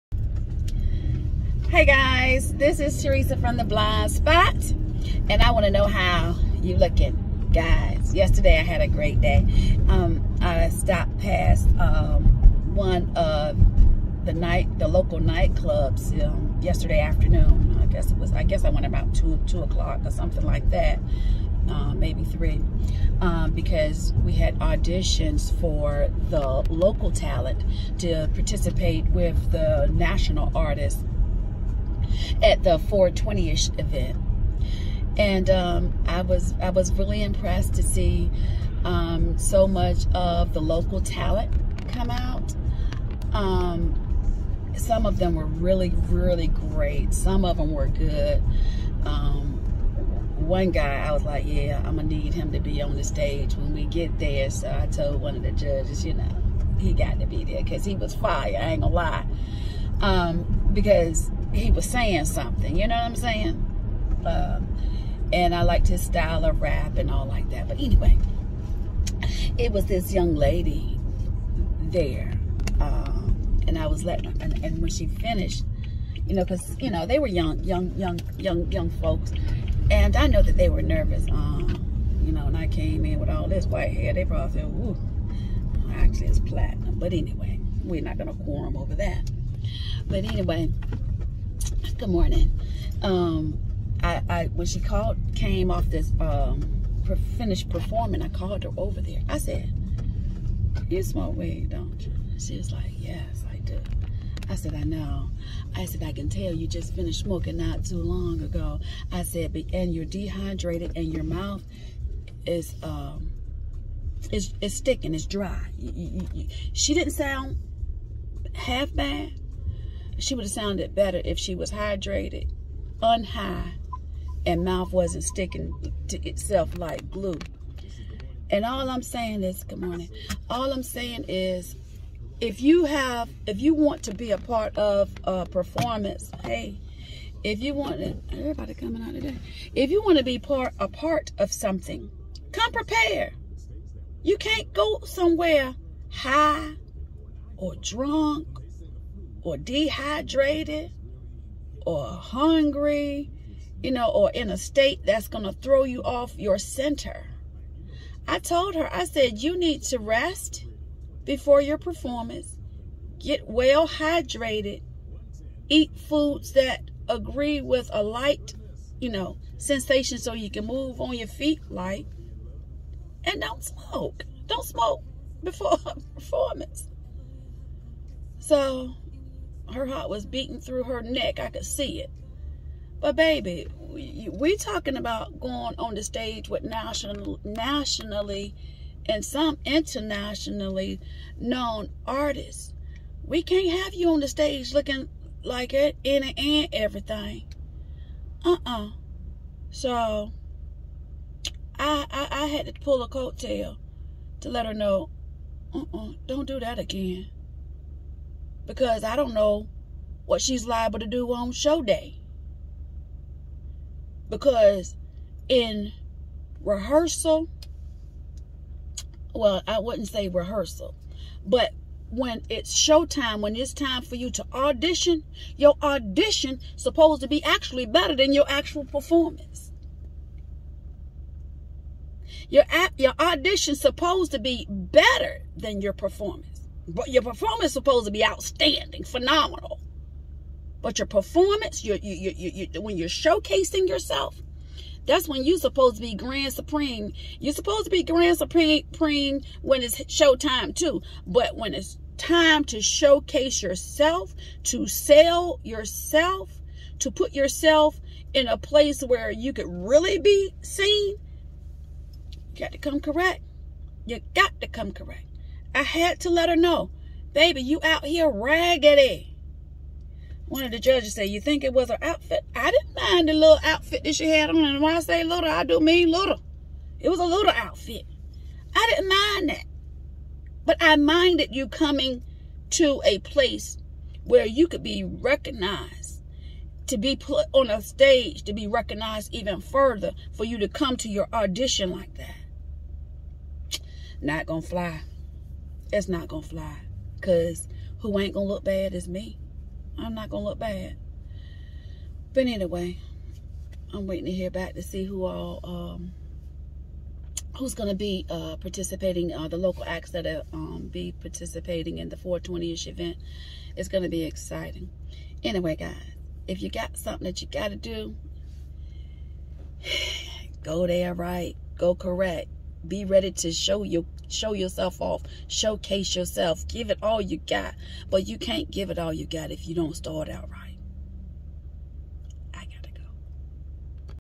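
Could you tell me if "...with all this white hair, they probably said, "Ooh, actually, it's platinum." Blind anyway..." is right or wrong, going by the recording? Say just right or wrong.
wrong.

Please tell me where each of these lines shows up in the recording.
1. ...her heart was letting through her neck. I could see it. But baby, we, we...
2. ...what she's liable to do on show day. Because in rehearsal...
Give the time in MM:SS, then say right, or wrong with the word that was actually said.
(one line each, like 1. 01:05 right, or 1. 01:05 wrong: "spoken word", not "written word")
1. 02:59 wrong: "beating", not "letting"
2. 03:30 right.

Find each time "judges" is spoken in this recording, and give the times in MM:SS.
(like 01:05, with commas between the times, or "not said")
00:55, 04:30.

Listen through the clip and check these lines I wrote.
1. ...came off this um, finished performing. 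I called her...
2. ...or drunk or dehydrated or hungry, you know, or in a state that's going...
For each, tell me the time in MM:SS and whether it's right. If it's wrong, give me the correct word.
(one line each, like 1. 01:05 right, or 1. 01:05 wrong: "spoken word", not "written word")
1. 01:35 right
2. 02:27 right.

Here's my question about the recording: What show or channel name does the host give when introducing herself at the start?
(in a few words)
The Blind Spot.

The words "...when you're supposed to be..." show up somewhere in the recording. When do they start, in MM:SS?
04:05.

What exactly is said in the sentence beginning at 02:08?
And all I'm saying is, good morning.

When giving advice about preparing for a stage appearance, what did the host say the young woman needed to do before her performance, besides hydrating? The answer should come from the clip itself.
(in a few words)
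rest.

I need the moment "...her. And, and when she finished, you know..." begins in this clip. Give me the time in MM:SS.
01:14.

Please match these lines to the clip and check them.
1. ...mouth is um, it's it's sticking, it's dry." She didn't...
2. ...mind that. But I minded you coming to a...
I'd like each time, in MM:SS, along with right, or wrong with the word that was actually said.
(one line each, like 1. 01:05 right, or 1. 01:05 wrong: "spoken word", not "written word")
1. 01:51 right
2. 04:39 right.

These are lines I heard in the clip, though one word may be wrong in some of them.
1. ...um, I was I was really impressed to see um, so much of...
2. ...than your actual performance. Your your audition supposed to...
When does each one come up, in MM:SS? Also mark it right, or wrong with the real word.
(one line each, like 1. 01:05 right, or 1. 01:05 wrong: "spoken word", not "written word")
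1. 00:35 right
2. 03:48 right.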